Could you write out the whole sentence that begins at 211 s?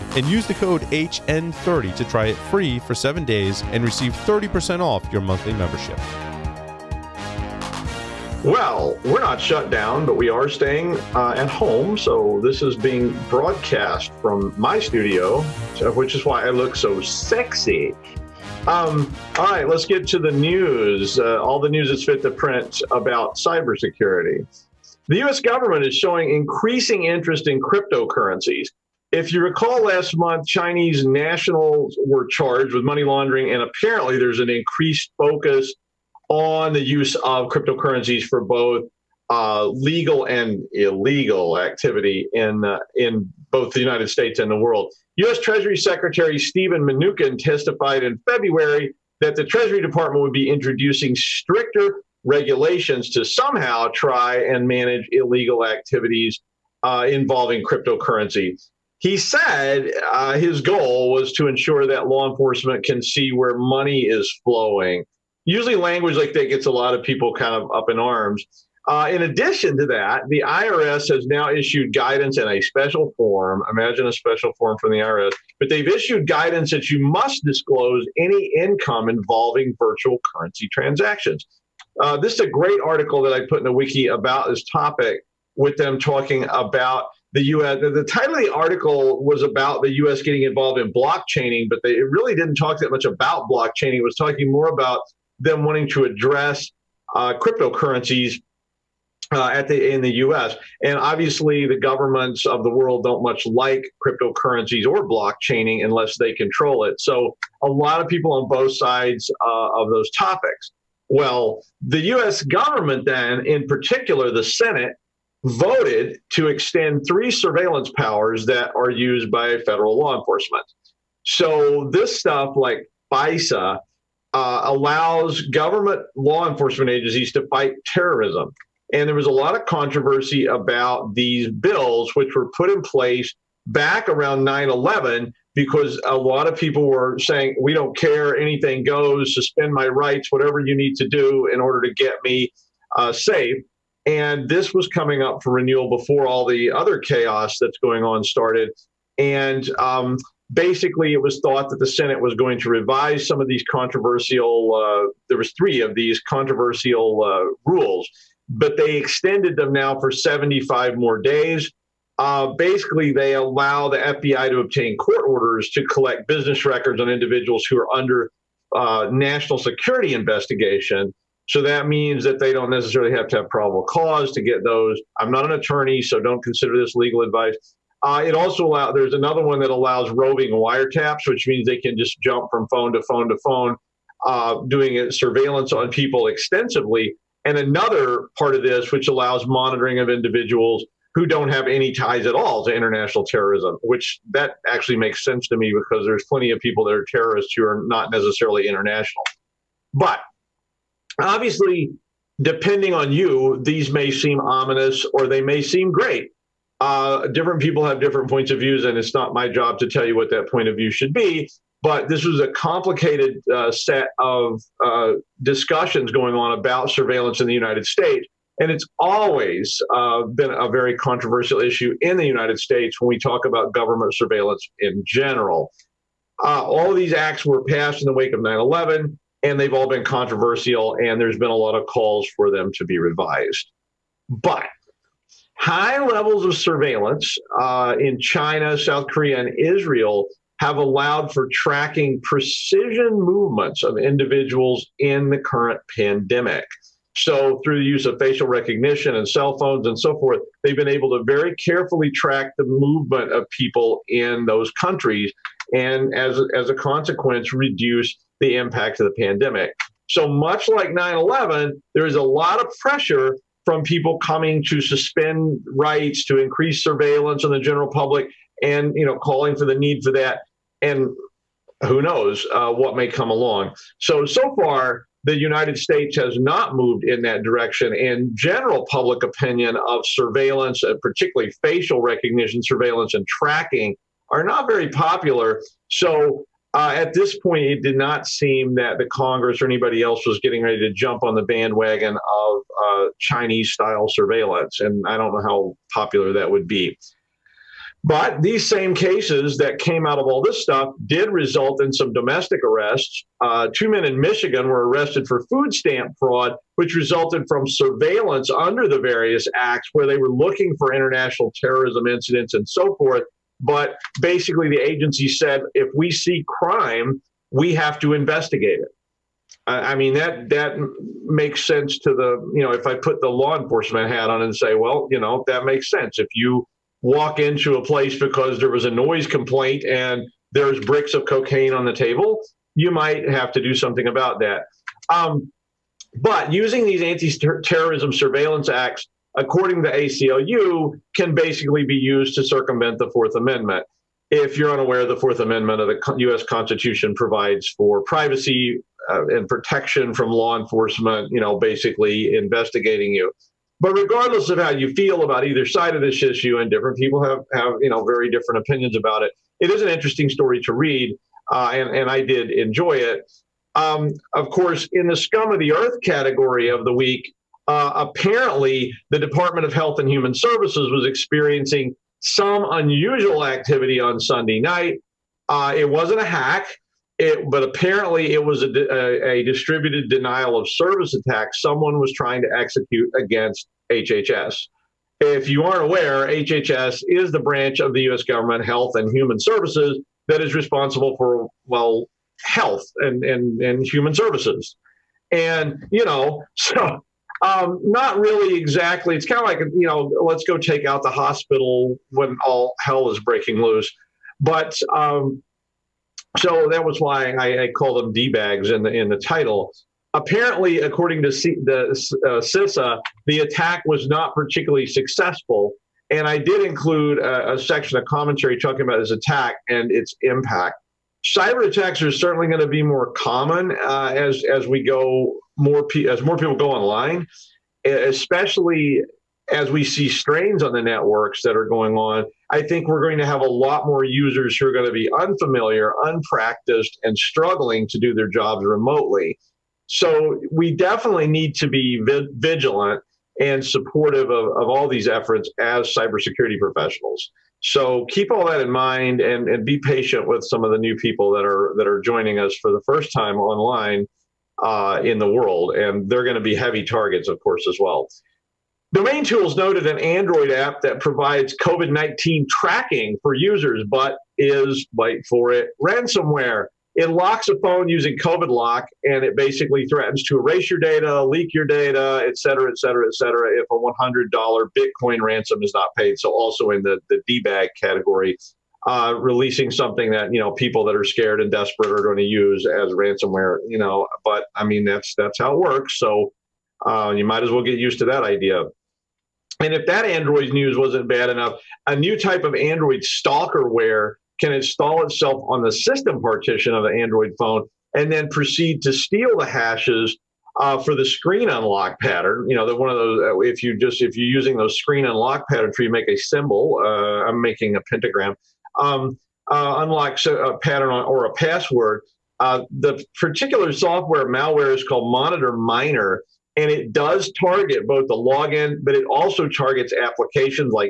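But this was a complicated uh, set of uh, discussions going on about surveillance in the United States.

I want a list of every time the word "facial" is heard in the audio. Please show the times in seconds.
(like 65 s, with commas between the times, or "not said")
248 s, 281 s.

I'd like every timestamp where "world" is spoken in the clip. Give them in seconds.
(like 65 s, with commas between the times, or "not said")
44 s, 102 s, 455 s.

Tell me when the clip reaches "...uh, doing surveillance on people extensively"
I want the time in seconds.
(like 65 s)
184 s.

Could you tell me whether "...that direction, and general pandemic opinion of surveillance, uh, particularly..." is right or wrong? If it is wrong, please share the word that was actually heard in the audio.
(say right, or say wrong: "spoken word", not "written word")
wrong: "public", not "pandemic".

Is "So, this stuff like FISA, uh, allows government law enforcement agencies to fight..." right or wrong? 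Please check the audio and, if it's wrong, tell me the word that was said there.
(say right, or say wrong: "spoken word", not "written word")
right.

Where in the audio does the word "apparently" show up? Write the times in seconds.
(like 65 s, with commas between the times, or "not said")
33 s, 367 s, 377 s, 410 s.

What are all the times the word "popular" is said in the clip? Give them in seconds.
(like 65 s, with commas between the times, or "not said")
284 s, 295 s.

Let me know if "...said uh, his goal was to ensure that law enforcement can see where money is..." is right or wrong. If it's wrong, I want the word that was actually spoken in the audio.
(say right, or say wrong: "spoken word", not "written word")
right.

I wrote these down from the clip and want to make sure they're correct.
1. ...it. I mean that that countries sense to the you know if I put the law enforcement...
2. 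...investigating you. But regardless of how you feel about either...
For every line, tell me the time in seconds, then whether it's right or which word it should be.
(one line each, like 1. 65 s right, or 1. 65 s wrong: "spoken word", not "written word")
1. 318 s wrong: "makes", not "countries"
2. 352 s right.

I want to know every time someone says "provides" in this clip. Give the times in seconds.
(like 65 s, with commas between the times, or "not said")
347 s, 460 s.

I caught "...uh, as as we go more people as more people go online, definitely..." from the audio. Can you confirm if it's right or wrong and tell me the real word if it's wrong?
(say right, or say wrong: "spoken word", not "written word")
wrong: "especially", not "definitely".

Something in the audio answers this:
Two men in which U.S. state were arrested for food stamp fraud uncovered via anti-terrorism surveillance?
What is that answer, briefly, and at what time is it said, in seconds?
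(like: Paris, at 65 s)
Michigan, at 304 s.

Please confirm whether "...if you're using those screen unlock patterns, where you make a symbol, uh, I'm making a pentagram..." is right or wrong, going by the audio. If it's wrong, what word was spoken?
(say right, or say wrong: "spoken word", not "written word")
right.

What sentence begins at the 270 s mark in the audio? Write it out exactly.
And who knows uh, what may come along.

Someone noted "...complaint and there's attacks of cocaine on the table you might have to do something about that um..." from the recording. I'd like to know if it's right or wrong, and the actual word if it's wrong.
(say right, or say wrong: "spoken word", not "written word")
wrong: "bricks", not "attacks".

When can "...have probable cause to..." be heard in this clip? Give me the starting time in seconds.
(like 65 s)
173 s.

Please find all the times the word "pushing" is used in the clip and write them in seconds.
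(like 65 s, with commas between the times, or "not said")
not said.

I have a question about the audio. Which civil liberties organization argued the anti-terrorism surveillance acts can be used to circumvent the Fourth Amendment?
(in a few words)
ACLU.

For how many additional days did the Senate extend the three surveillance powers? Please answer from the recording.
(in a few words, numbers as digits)
75.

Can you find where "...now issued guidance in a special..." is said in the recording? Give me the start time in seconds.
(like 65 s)
71 s.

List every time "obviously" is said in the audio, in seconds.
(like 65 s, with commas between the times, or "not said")
100 s, 201 s.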